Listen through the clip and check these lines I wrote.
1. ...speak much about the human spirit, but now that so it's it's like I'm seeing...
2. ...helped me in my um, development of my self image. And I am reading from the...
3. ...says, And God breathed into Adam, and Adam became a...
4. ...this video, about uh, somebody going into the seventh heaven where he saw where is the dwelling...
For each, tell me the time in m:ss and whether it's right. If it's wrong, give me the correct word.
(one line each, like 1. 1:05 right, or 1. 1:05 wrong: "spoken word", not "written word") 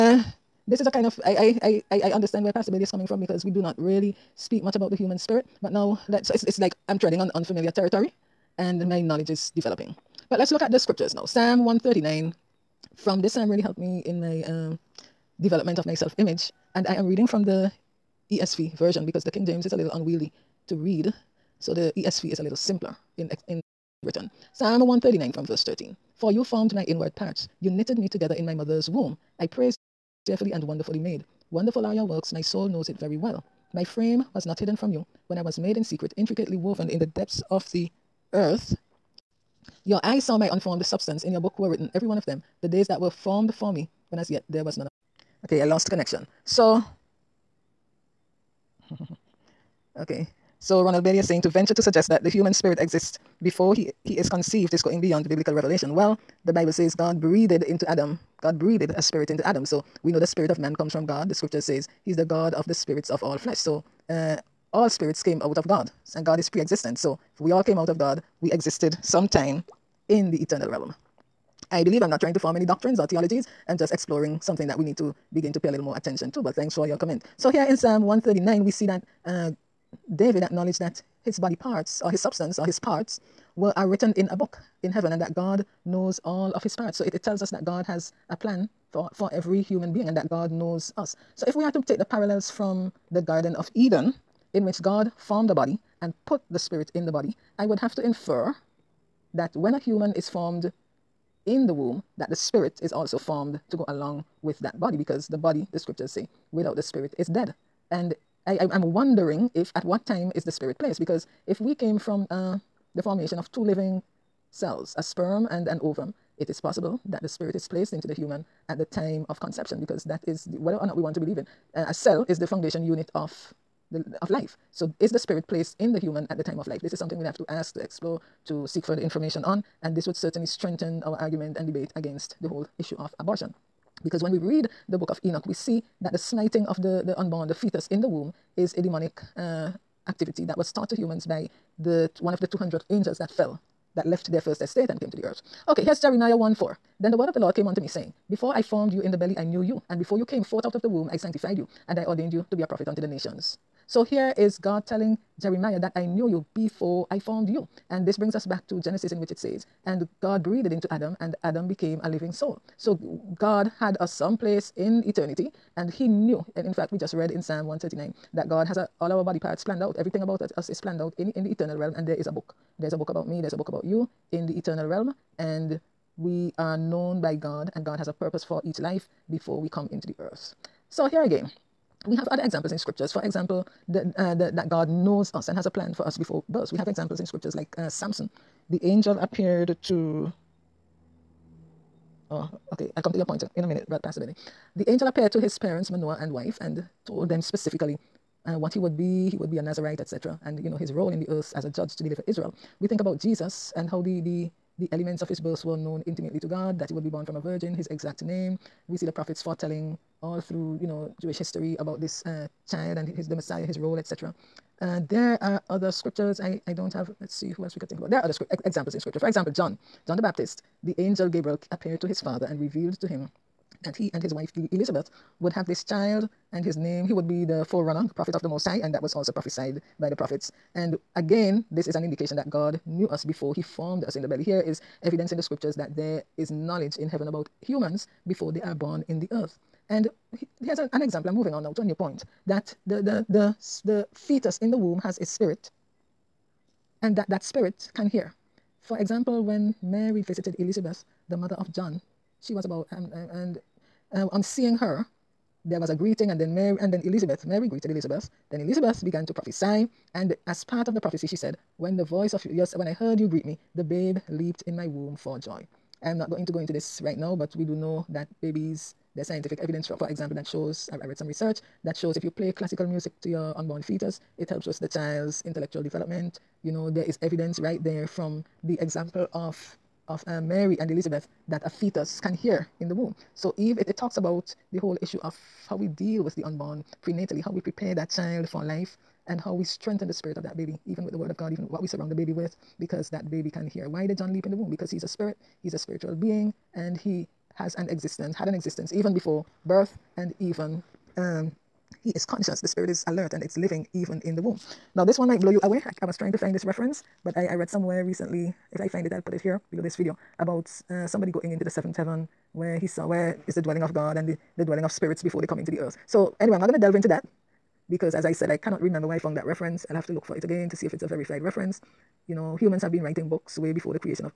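1. 0:04 wrong: "treading", not "seeing"
2. 0:13 right
3. 2:39 right
4. 5:09 right.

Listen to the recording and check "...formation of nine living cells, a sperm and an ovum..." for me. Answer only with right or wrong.
wrong.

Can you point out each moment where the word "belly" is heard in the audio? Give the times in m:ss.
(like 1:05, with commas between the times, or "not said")
2:29, 3:54.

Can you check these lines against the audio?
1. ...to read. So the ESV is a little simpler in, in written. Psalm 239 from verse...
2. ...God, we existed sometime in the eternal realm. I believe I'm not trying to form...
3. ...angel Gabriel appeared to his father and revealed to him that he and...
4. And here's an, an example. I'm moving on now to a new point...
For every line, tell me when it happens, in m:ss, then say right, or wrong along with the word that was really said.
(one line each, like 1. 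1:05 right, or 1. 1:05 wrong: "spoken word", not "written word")
1. 0:20 wrong: "139", not "239"
2. 1:07 right
3. 3:40 right
4. 3:59 right.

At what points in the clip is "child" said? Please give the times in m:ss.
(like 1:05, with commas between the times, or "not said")
3:32, 3:45, 4:34, 4:48.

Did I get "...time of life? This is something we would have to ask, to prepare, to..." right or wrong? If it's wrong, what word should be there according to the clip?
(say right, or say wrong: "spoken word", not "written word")
wrong: "explore", not "prepare".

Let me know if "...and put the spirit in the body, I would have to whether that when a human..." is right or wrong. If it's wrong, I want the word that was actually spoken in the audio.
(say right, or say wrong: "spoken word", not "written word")
wrong: "infer", not "whether".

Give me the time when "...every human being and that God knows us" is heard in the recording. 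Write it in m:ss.
1:29.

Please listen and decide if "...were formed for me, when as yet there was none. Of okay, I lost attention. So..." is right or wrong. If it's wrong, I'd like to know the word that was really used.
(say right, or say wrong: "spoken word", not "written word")
wrong: "connection", not "attention".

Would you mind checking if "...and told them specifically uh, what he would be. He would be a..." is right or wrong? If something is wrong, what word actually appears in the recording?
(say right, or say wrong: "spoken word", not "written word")
right.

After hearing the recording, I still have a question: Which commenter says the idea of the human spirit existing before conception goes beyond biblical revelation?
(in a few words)
Ronald Bailey.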